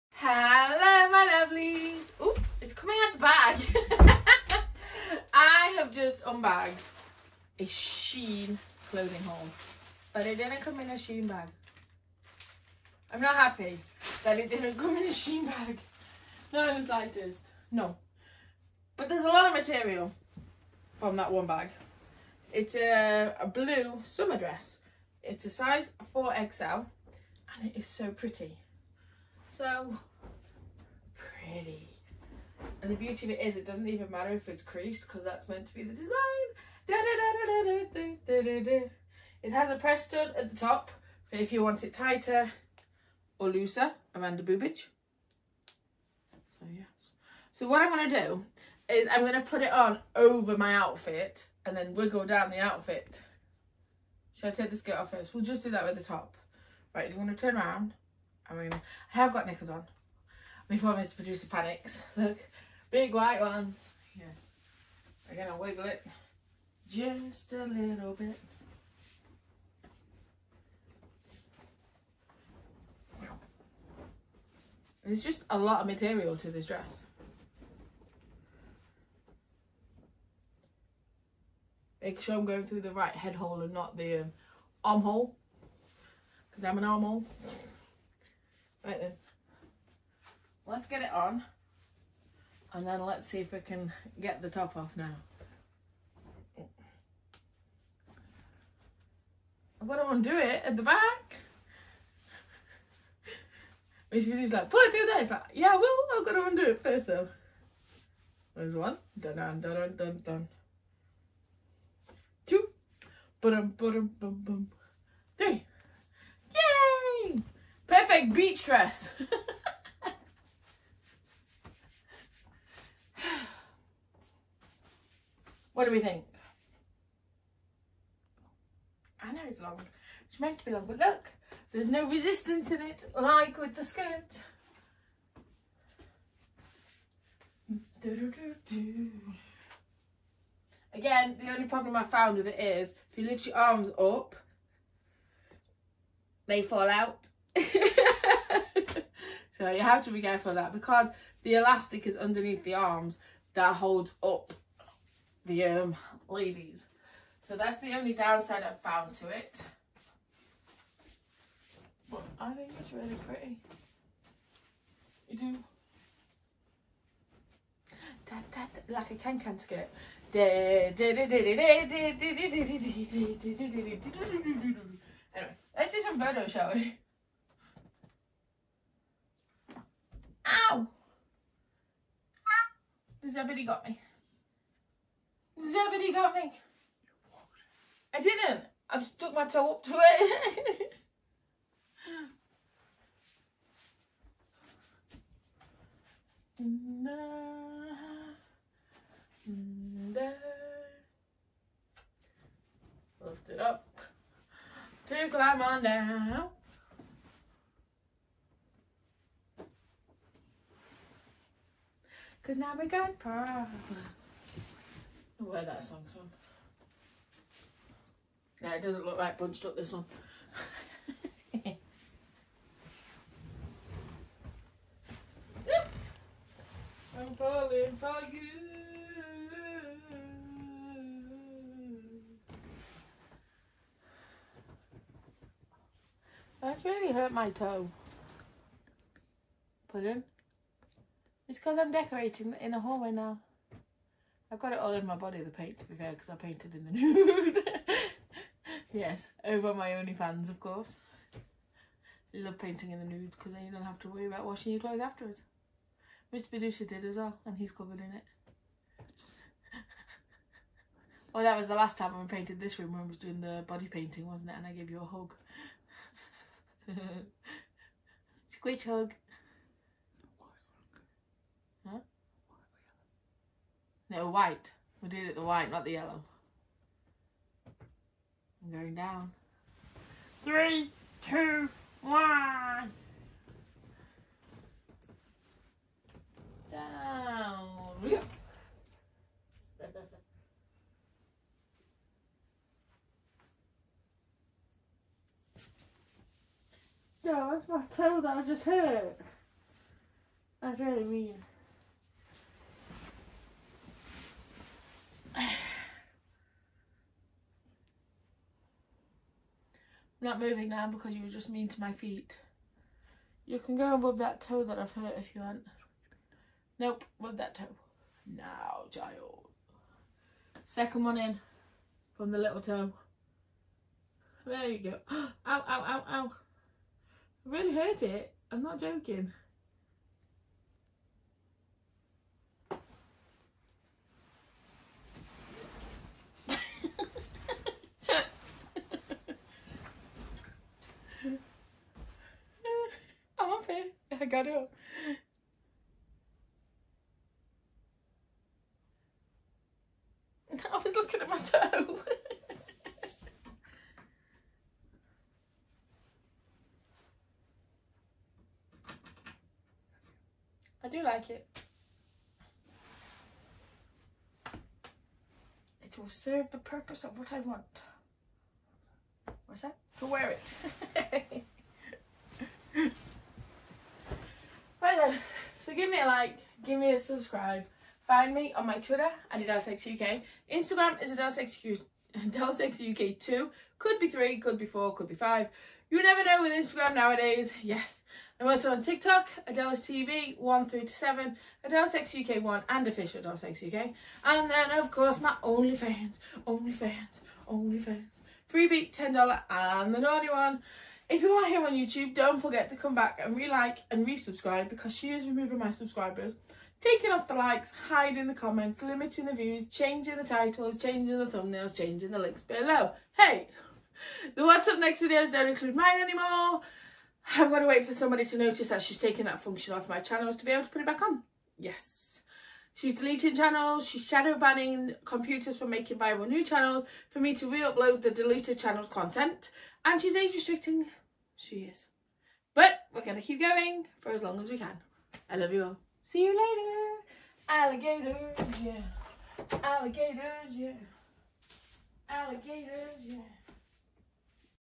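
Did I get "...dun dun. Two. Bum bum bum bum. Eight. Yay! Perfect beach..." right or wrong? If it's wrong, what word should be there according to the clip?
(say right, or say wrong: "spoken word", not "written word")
wrong: "Three", not "Eight".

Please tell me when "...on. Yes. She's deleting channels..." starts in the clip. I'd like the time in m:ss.
7:01.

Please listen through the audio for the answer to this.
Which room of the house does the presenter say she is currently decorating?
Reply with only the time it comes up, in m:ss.
4:02.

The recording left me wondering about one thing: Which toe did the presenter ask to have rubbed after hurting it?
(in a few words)
Second one in from the little toe.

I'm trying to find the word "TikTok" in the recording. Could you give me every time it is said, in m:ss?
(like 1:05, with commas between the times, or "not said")
6:28.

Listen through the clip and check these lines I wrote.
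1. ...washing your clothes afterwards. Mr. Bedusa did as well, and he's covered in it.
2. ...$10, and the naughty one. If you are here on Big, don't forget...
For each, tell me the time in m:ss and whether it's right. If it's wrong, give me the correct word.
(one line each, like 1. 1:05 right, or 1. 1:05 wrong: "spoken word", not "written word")
1. 4:14 right
2. 6:38 wrong: "YouTube", not "Big".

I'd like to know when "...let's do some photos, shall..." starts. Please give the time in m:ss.
2:55.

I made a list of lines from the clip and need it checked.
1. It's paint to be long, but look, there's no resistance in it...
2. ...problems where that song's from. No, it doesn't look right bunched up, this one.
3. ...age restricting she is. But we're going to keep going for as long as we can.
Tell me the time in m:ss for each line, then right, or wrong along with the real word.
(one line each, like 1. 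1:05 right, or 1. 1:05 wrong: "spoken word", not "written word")
1. 2:10 wrong: "meant", not "paint"
2. 3:33 right
3. 7:10 right.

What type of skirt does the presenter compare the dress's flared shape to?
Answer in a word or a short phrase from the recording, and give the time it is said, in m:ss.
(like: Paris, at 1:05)
Can-can skirt, at 2:49.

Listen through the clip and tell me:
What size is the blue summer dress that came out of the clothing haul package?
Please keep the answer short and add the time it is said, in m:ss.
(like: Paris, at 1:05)
4XL, at 0:26.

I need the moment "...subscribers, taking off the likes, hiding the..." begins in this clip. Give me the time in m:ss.
6:45.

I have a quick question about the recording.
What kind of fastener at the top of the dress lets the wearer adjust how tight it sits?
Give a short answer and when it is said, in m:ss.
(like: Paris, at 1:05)
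Press stud, at 0:39.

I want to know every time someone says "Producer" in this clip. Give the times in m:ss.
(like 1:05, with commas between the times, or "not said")
1:01.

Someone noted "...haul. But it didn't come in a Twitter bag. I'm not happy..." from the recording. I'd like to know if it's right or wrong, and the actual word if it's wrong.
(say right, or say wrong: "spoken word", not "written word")
wrong: "Shein", not "Twitter".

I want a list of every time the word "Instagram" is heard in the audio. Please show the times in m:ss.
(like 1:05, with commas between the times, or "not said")
6:20, 6:26.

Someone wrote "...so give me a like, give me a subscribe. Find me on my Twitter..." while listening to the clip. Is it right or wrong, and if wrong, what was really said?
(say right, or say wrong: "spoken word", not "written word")
right.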